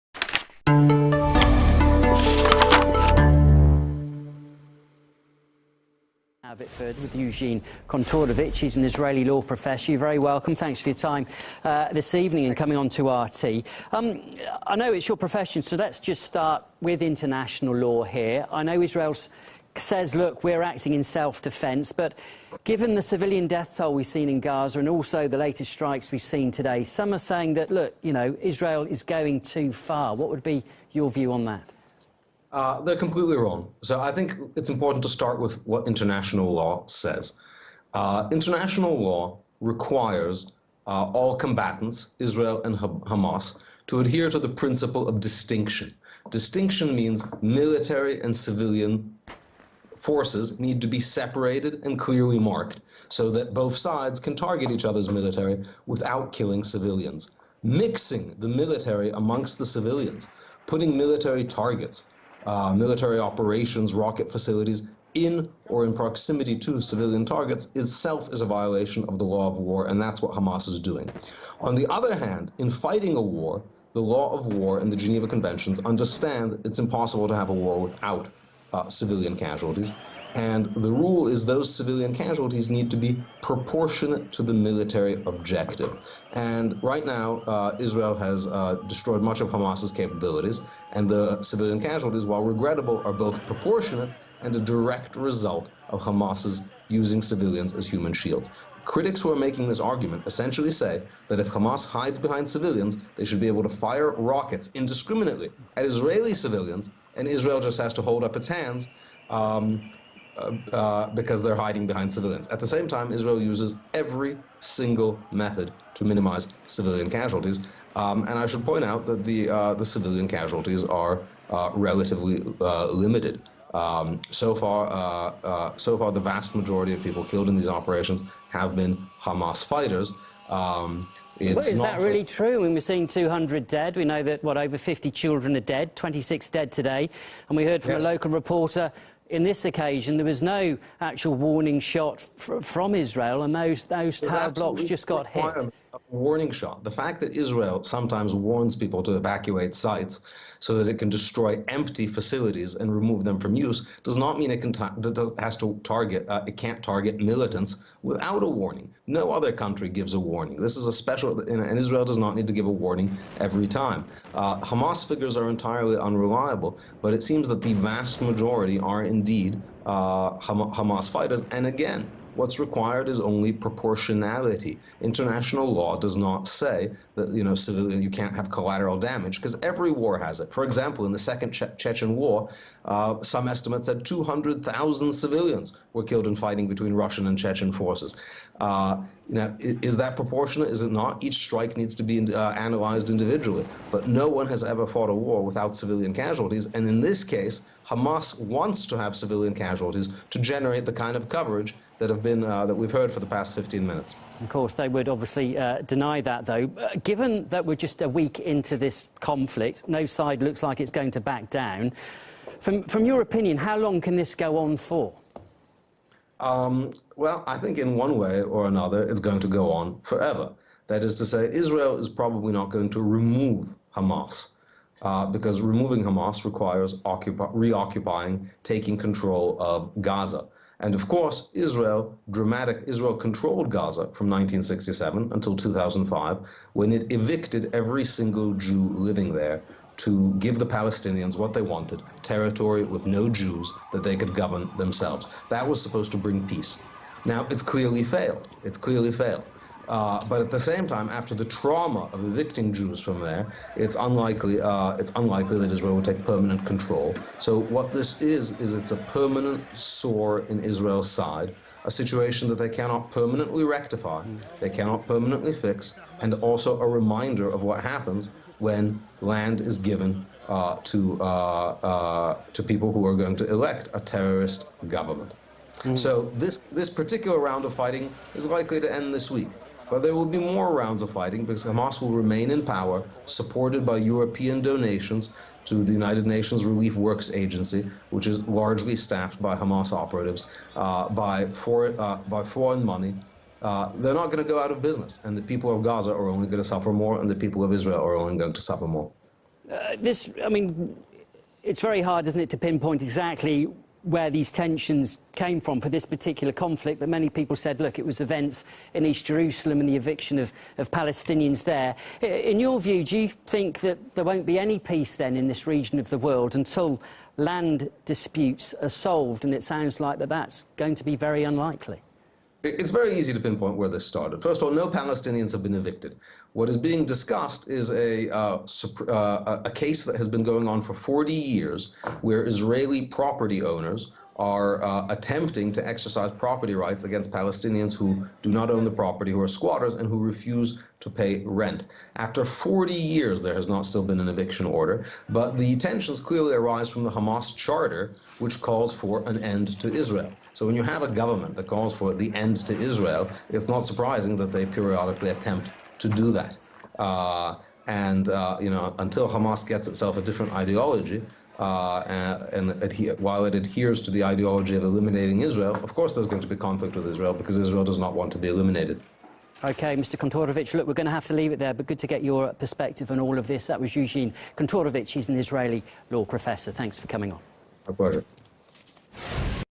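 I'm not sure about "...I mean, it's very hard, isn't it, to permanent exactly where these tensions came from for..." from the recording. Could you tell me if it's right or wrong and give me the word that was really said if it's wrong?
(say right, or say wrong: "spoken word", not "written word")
wrong: "pinpoint", not "permanent".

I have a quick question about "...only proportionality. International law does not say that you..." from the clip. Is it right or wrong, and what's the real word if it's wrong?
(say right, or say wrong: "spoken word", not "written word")
right.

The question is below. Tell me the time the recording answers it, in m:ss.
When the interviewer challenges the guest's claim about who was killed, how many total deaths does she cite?
2:13.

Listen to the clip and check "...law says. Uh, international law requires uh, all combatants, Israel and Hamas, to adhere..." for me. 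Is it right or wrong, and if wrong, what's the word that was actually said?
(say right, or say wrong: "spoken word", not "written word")
right.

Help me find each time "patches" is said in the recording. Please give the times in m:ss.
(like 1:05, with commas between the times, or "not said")
not said.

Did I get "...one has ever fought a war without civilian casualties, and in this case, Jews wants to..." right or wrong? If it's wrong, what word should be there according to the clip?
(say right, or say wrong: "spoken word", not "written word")
wrong: "Hamas", not "Jews".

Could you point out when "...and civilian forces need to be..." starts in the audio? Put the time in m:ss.
0:48.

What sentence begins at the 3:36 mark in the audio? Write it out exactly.
Um, well, I think in one way or another, it's going to go on forever.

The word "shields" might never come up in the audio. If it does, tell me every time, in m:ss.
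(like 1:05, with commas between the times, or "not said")
1:38.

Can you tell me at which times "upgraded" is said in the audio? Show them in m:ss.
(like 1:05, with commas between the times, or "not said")
not said.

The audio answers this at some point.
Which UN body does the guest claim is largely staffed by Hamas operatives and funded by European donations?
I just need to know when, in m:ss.
4:45.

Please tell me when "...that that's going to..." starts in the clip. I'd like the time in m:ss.
5:20.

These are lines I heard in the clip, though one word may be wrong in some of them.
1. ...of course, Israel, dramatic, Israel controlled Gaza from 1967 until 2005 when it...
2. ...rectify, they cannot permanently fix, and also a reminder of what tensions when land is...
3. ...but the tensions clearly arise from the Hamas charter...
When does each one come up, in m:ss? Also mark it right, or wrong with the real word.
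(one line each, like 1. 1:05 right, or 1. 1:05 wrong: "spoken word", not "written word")
1. 3:50 right
2. 4:23 wrong: "happens", not "tensions"
3. 5:45 right.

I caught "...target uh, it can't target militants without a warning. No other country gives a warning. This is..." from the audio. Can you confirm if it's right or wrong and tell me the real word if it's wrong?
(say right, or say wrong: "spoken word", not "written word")
right.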